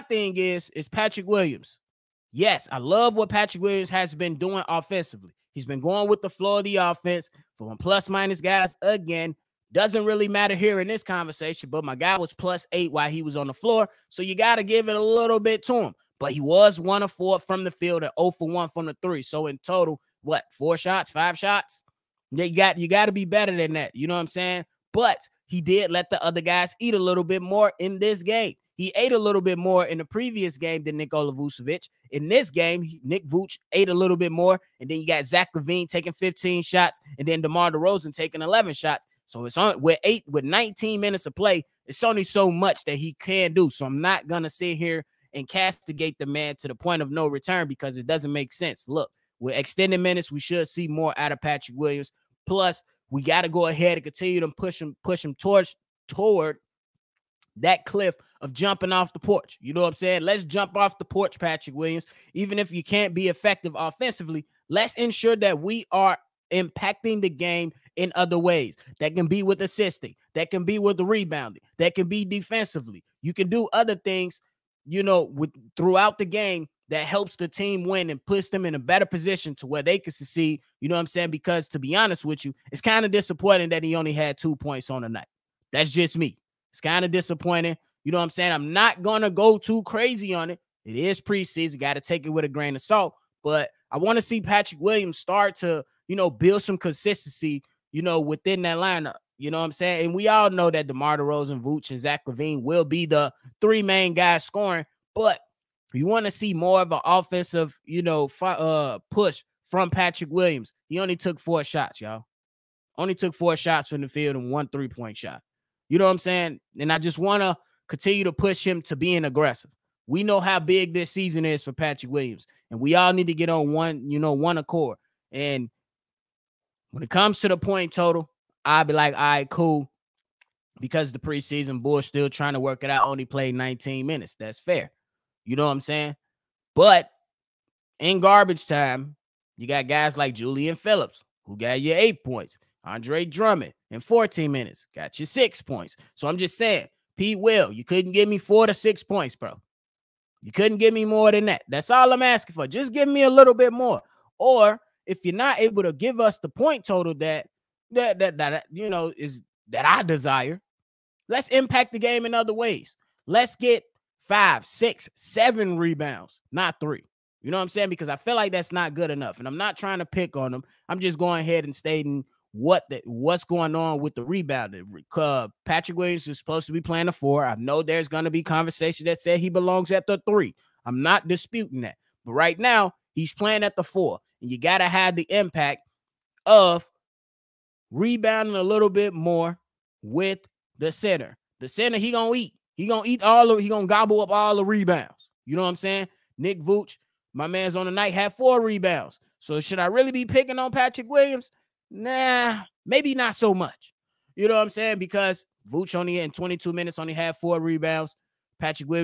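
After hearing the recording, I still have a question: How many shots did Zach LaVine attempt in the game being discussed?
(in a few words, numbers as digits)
15.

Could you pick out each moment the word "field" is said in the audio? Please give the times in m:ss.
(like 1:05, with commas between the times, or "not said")
0:17, 1:54.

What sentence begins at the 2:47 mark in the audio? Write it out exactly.
Because I feel like that's not good enough.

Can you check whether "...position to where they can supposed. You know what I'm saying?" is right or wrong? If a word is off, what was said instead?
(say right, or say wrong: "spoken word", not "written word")
wrong: "succeed", not "supposed".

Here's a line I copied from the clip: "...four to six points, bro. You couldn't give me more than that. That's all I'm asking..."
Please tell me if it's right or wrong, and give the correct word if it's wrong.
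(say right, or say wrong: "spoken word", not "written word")
right.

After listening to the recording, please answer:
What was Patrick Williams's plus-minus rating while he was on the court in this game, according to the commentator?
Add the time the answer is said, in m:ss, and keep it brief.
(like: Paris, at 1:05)
+8, at 0:12.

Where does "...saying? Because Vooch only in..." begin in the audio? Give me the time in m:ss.
3:24.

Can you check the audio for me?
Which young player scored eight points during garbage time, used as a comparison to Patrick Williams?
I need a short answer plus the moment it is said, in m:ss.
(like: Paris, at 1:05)
Julian Phillips, at 2:20.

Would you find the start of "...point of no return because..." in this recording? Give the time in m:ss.
0:46.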